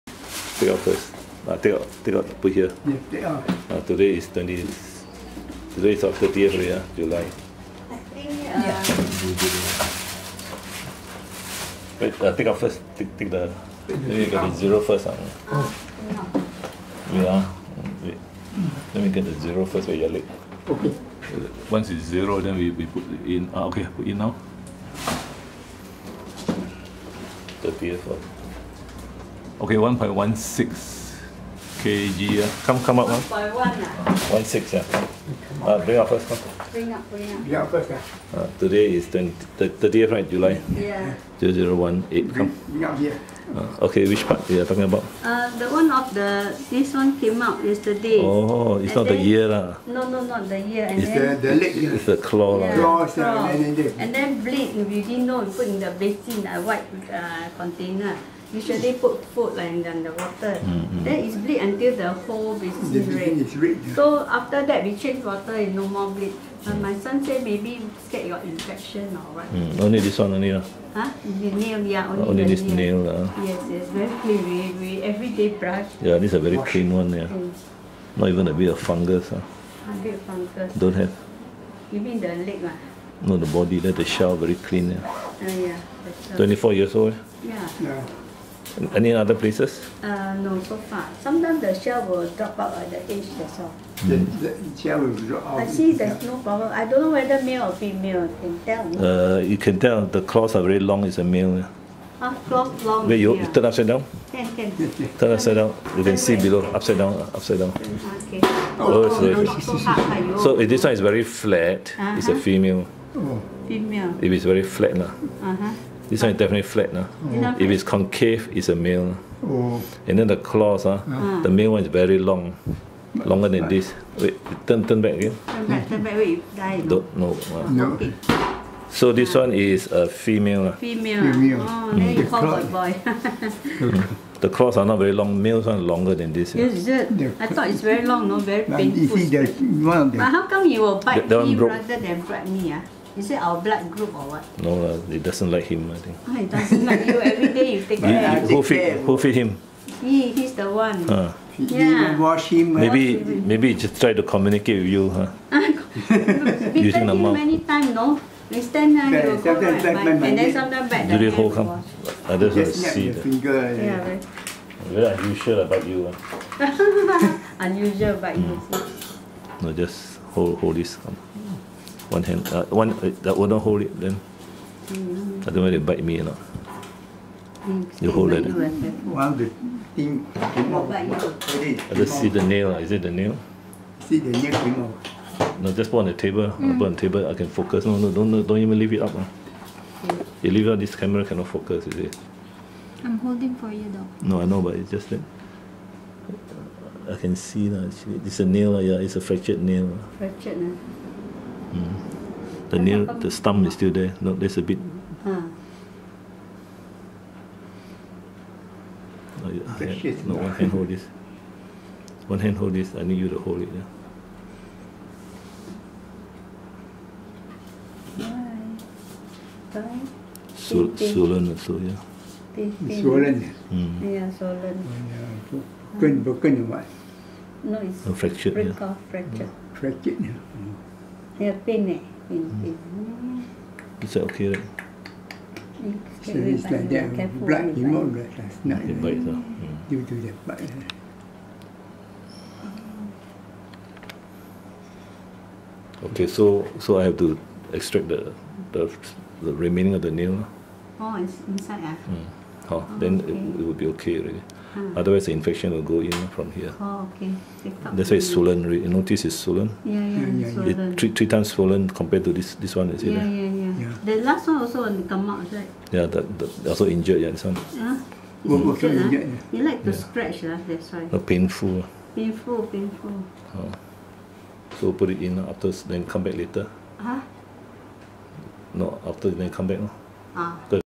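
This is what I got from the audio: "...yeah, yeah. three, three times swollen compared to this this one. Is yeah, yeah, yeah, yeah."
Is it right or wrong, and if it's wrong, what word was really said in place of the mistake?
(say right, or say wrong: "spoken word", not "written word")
right.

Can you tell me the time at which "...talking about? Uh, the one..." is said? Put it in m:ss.
0:44.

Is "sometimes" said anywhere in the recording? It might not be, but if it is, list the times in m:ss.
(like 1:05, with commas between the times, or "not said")
1:31, 2:40.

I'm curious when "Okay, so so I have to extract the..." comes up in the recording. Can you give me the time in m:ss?
4:06.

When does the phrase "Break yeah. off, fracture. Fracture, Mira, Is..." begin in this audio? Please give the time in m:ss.
3:48.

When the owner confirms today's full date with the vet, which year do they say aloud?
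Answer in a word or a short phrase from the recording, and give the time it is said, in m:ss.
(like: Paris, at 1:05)
2018, at 0:41.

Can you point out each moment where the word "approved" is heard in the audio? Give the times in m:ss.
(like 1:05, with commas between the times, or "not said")
not said.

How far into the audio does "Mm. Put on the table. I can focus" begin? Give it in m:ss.
3:06.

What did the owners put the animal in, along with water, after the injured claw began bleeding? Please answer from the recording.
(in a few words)
basin.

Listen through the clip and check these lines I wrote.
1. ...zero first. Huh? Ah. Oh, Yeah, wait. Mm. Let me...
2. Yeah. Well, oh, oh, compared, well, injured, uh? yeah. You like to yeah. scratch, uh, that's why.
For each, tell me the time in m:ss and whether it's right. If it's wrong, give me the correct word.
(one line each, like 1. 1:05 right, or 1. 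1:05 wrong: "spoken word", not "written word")
1. 0:14 right
2. 4:27 wrong: "injured", not "compared".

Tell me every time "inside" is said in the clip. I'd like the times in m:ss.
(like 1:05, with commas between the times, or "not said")
4:11.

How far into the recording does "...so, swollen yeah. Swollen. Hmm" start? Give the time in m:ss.
3:40.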